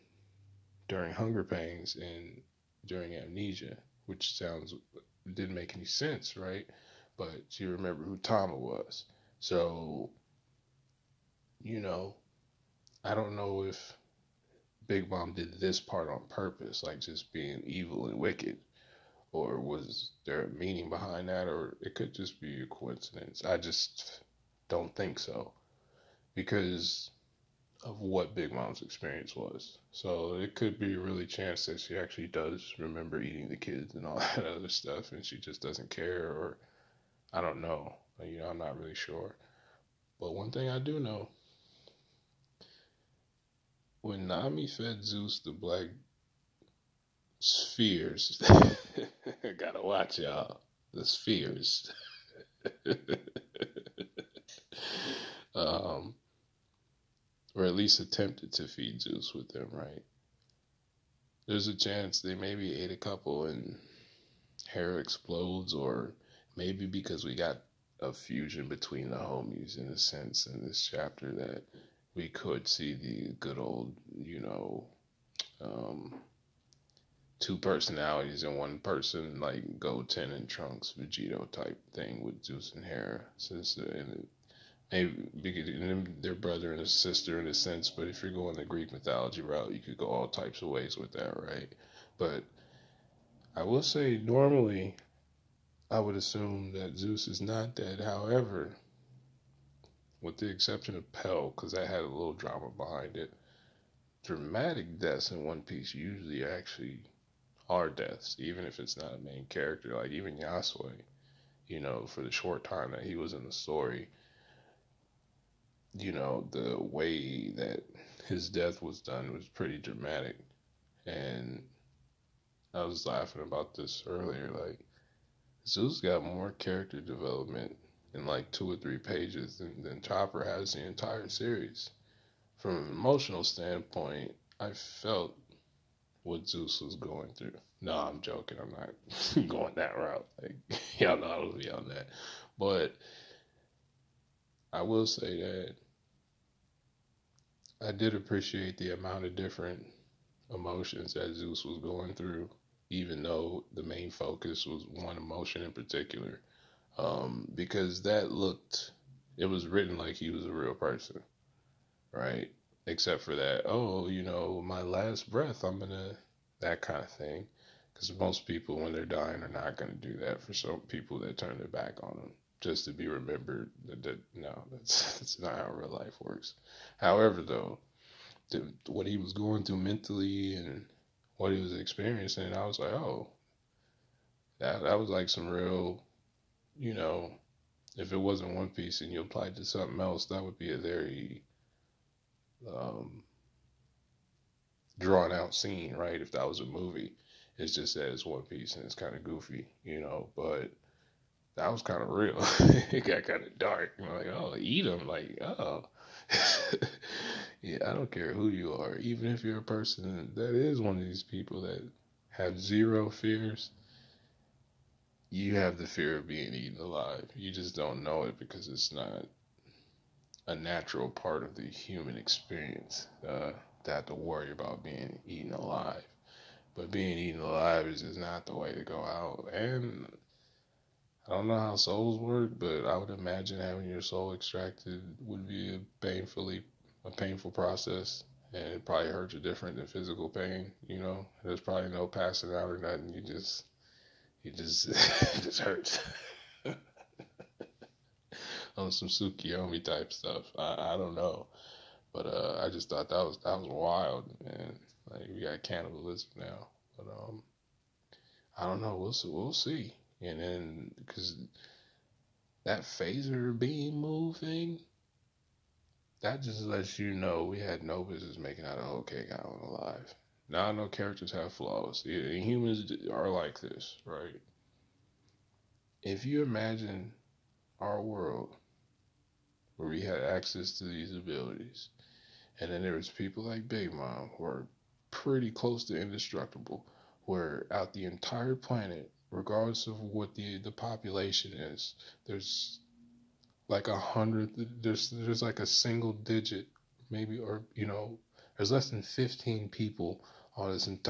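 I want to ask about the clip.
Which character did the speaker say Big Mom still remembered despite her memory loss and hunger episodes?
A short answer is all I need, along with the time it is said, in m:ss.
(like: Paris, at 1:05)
Tama, at 0:08.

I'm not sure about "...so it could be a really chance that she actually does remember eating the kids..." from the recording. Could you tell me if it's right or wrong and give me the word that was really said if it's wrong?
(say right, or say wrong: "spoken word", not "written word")
right.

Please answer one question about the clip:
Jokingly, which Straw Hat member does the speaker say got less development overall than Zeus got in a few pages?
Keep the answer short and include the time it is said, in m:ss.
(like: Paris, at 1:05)
Chopper, at 2:10.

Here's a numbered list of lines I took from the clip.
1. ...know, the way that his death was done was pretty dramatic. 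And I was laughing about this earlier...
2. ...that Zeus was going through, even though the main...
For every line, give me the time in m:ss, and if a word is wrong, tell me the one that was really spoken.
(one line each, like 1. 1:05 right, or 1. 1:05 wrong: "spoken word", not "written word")
1. 1:56 right
2. 2:31 right.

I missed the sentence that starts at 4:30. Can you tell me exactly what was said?
Now I know characters have flaws.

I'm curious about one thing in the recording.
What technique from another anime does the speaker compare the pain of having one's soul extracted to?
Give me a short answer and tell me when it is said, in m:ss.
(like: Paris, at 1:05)
Tsukiyomi, at 4:09.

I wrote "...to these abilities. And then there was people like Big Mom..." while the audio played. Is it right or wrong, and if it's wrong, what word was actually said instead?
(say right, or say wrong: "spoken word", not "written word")
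right.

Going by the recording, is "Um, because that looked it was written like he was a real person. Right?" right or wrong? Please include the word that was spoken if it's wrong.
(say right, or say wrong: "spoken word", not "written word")
right.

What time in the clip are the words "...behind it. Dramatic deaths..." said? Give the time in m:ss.
1:42.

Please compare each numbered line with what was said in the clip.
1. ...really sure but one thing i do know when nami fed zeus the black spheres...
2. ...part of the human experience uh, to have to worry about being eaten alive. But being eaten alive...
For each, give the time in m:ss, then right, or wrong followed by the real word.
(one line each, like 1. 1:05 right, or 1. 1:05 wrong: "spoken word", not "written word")
1. 0:38 right
2. 3:41 right.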